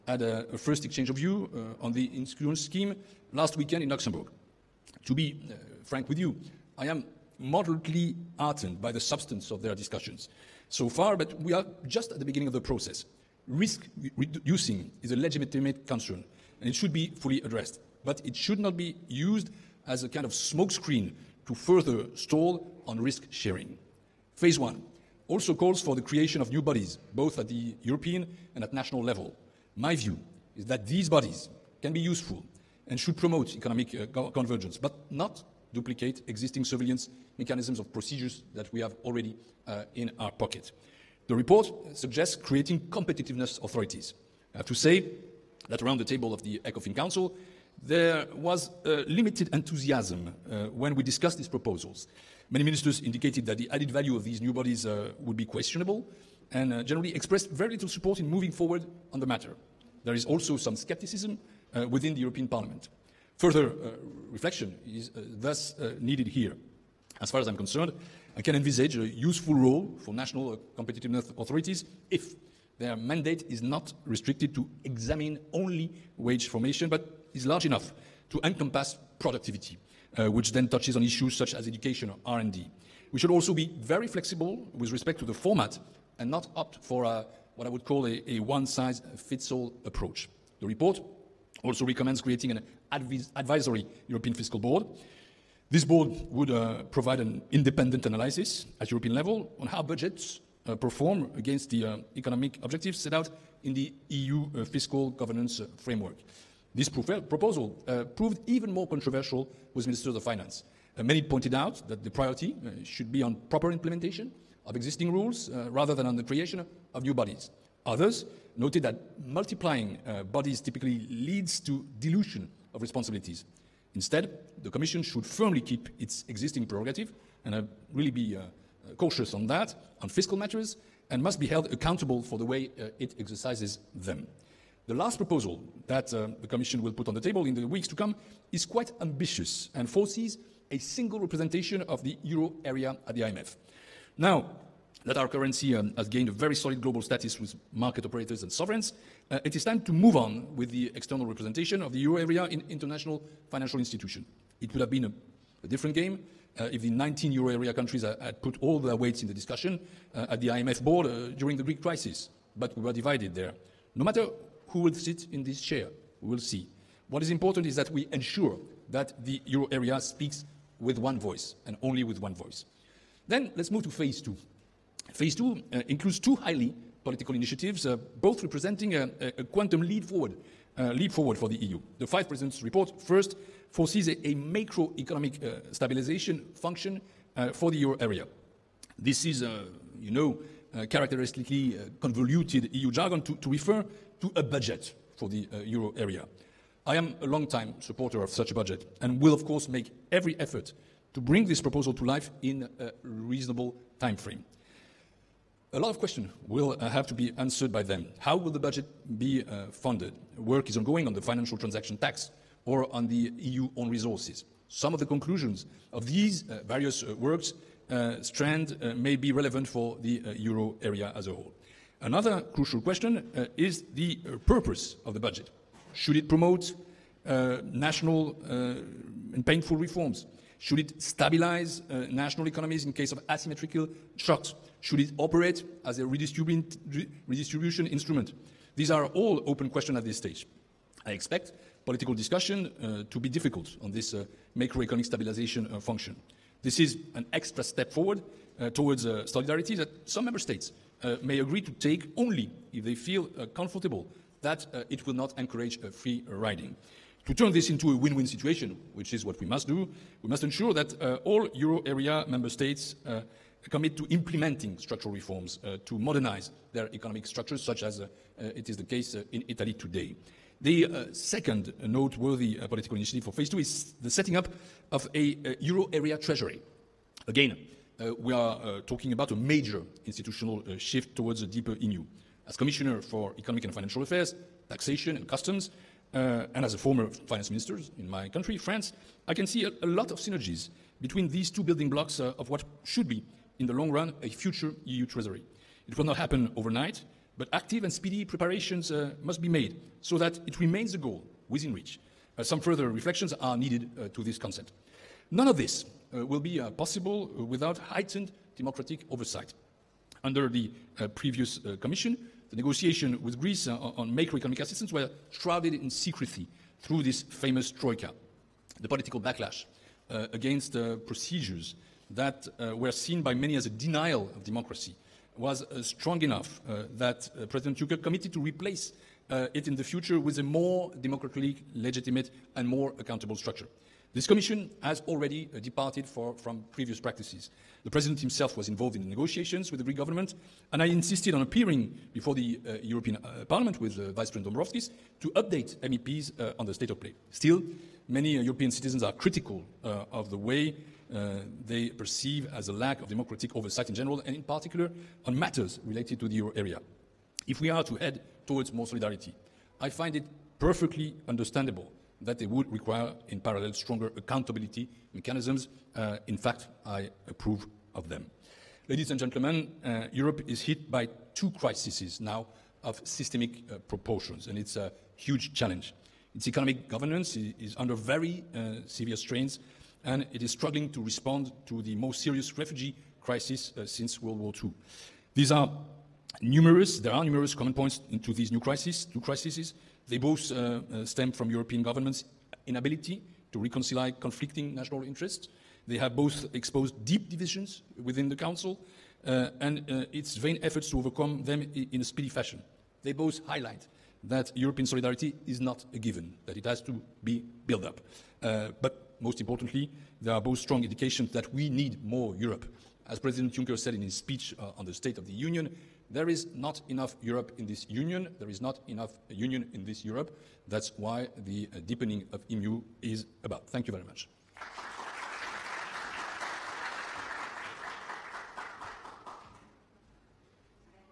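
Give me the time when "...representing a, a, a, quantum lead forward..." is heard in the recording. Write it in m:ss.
2:58.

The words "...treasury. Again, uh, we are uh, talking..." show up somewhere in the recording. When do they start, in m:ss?
4:36.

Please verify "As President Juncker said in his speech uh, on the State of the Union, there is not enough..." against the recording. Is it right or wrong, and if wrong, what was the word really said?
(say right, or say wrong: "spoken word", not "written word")
right.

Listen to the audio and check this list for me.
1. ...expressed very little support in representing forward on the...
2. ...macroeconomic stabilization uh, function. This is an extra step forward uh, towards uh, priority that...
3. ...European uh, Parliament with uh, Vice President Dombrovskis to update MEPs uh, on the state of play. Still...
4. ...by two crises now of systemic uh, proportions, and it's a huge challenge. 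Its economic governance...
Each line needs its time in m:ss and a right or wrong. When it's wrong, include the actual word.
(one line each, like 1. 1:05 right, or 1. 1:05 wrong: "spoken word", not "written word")
1. 0:57 wrong: "moving", not "representing"
2. 4:04 wrong: "solidarity", not "priority"
3. 5:42 right
4. 6:10 right.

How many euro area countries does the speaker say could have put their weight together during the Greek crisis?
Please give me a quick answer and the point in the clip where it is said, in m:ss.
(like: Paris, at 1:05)
19, at 2:36.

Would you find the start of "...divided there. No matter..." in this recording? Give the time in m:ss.
2:42.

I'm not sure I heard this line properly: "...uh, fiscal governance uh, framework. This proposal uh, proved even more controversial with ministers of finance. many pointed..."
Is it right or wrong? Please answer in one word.
right.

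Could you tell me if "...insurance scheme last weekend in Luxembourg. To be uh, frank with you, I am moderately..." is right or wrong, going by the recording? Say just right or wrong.
right.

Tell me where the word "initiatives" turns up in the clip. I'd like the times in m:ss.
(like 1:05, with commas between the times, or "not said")
2:57, 4:32.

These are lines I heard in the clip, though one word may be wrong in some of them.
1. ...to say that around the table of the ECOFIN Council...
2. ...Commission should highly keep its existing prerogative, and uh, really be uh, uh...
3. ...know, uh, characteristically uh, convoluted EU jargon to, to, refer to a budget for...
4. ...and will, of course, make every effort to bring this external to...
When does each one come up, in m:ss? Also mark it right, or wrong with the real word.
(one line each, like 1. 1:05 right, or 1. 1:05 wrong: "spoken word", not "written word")
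1. 0:44 right
2. 2:04 wrong: "firmly", not "highly"
3. 3:10 right
4. 3:19 wrong: "proposal", not "external".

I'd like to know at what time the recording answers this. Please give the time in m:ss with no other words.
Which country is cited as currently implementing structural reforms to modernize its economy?
4:29.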